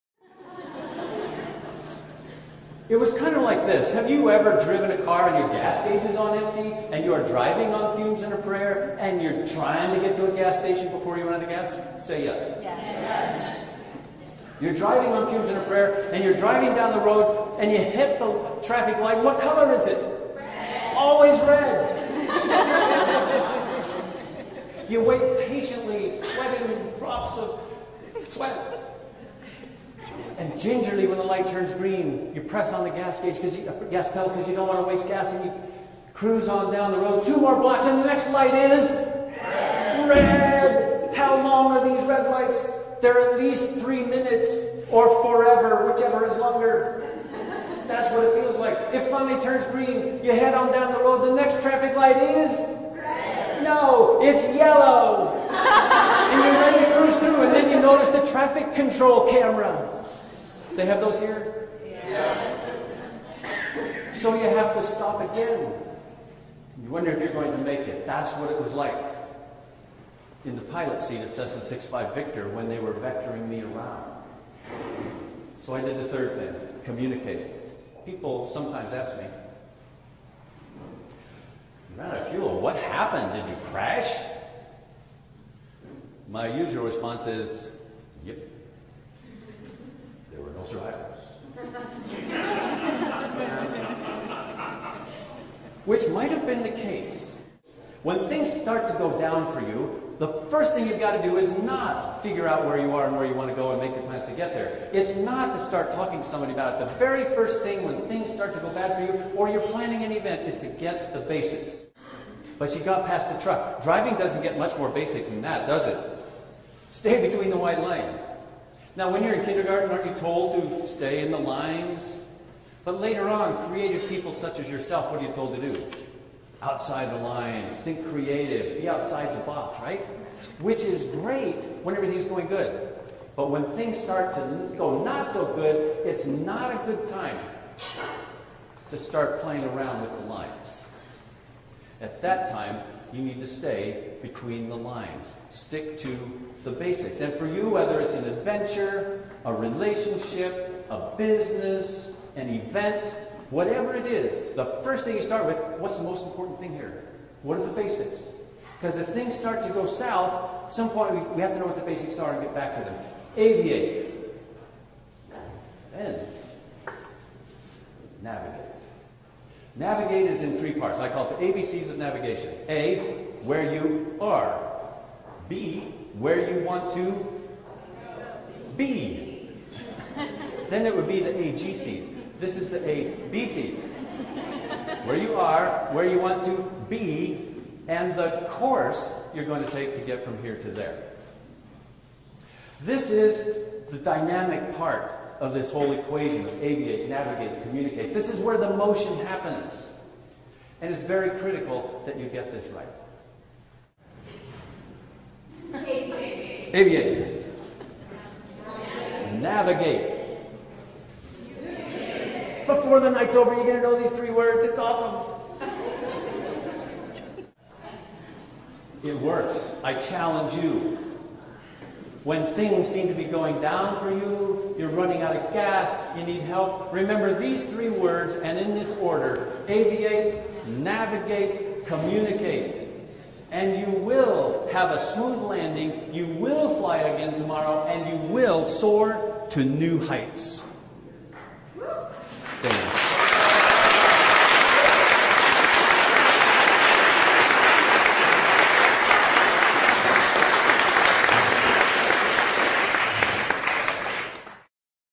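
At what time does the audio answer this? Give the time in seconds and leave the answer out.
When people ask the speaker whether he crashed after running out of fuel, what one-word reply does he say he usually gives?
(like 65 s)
88 s.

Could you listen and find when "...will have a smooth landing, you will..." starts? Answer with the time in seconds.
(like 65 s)
233 s.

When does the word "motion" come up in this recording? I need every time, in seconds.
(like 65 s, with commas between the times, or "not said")
198 s.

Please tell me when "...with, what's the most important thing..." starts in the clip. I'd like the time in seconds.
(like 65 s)
155 s.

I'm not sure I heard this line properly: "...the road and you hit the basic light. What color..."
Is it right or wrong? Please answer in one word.
wrong.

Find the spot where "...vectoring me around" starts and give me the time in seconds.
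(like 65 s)
72 s.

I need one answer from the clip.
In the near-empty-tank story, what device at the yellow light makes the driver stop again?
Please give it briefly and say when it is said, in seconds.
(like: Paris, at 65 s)
traffic control camera, at 58 s.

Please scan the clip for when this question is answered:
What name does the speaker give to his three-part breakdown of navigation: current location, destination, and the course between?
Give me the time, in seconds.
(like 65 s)
171 s.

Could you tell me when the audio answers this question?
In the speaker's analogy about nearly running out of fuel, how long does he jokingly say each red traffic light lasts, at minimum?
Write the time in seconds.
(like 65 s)
43 s.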